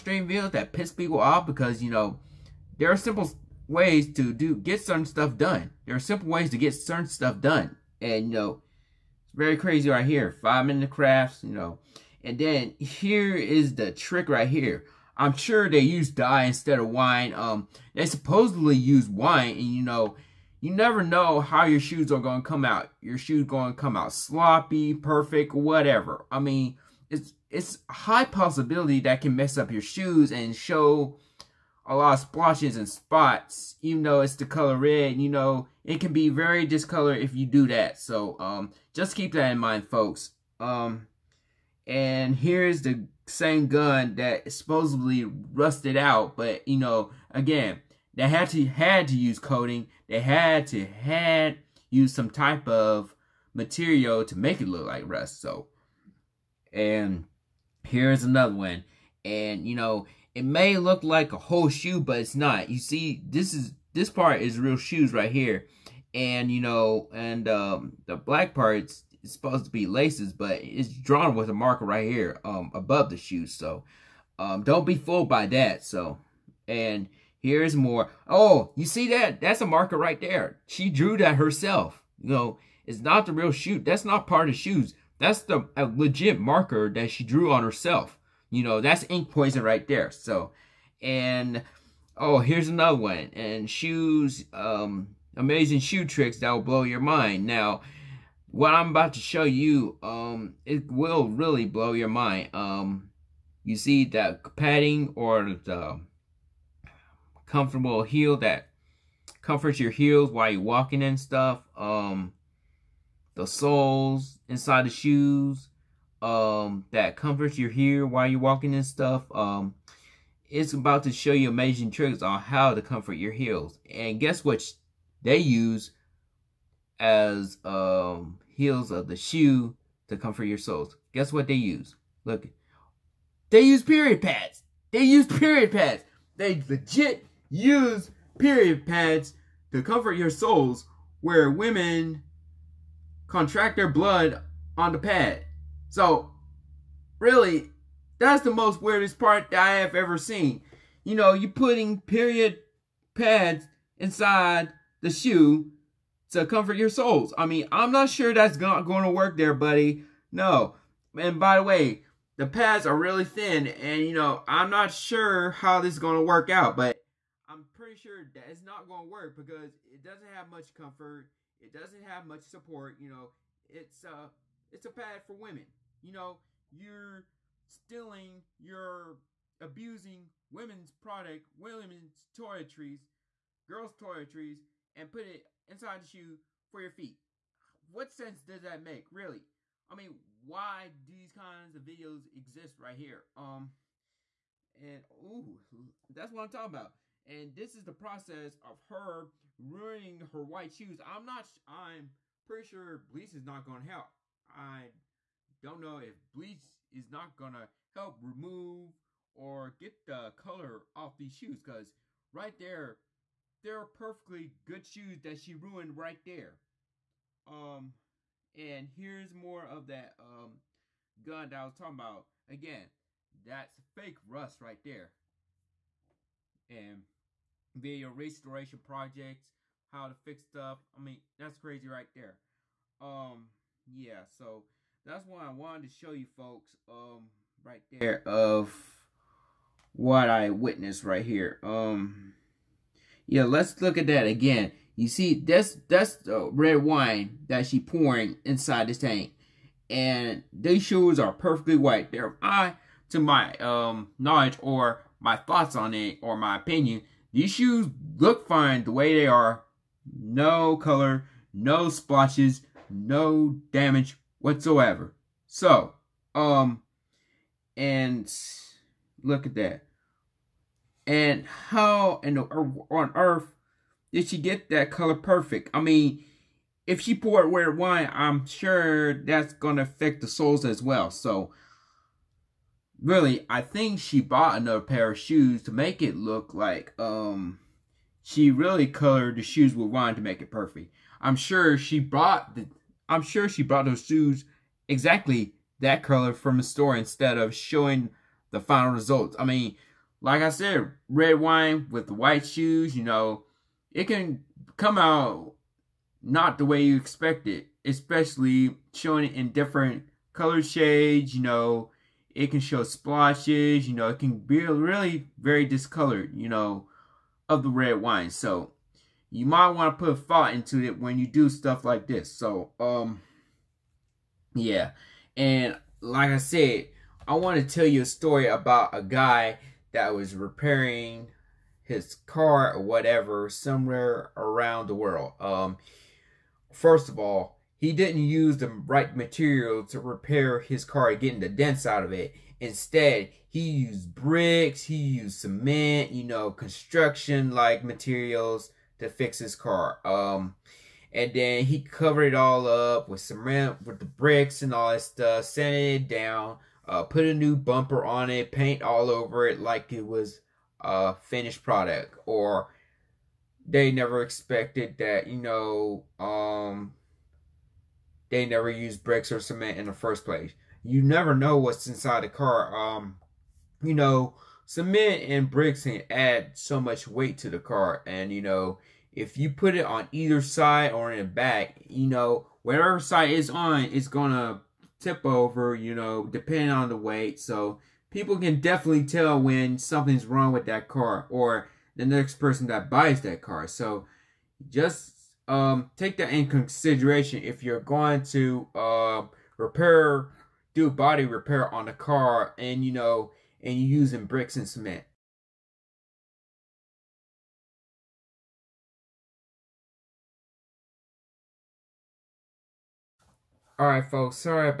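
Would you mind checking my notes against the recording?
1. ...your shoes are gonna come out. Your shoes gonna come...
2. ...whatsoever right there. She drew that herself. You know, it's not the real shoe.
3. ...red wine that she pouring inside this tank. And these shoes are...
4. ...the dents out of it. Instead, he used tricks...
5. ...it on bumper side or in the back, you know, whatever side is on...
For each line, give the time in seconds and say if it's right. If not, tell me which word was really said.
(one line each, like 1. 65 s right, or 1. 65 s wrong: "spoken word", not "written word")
1. 21 s right
2. 79 s wrong: "marker", not "whatsoever"
3. 246 s right
4. 341 s wrong: "bricks", not "tricks"
5. 379 s wrong: "either", not "bumper".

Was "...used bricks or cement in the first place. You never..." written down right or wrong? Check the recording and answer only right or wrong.
right.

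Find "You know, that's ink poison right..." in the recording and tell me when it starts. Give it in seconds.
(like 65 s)
88 s.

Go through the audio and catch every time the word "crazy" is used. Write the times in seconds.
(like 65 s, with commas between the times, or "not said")
9 s, 231 s.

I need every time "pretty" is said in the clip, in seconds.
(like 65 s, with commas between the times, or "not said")
167 s, 202 s.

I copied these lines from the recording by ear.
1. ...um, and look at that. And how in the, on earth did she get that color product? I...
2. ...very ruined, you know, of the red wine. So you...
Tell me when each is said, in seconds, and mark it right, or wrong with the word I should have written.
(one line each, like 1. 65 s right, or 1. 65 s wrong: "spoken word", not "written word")
1. 266 s wrong: "perfect", not "product"
2. 315 s wrong: "discolored", not "ruined".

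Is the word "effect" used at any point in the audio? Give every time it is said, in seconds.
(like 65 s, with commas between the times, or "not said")
not said.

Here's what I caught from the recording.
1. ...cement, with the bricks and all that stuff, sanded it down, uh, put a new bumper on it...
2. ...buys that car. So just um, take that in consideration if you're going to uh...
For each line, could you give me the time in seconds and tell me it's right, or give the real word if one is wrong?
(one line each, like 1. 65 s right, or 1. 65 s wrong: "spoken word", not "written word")
1. 353 s right
2. 392 s right.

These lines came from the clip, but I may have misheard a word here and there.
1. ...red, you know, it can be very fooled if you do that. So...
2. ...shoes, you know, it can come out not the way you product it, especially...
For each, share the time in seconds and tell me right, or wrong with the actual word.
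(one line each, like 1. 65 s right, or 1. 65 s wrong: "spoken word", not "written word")
1. 34 s wrong: "discolored", not "fooled"
2. 302 s wrong: "expect", not "product".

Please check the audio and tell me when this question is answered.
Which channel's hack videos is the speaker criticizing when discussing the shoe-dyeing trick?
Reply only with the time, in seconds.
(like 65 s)
10 s.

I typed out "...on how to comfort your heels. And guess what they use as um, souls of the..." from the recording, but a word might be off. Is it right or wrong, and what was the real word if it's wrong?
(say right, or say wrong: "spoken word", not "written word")
wrong: "heels", not "souls".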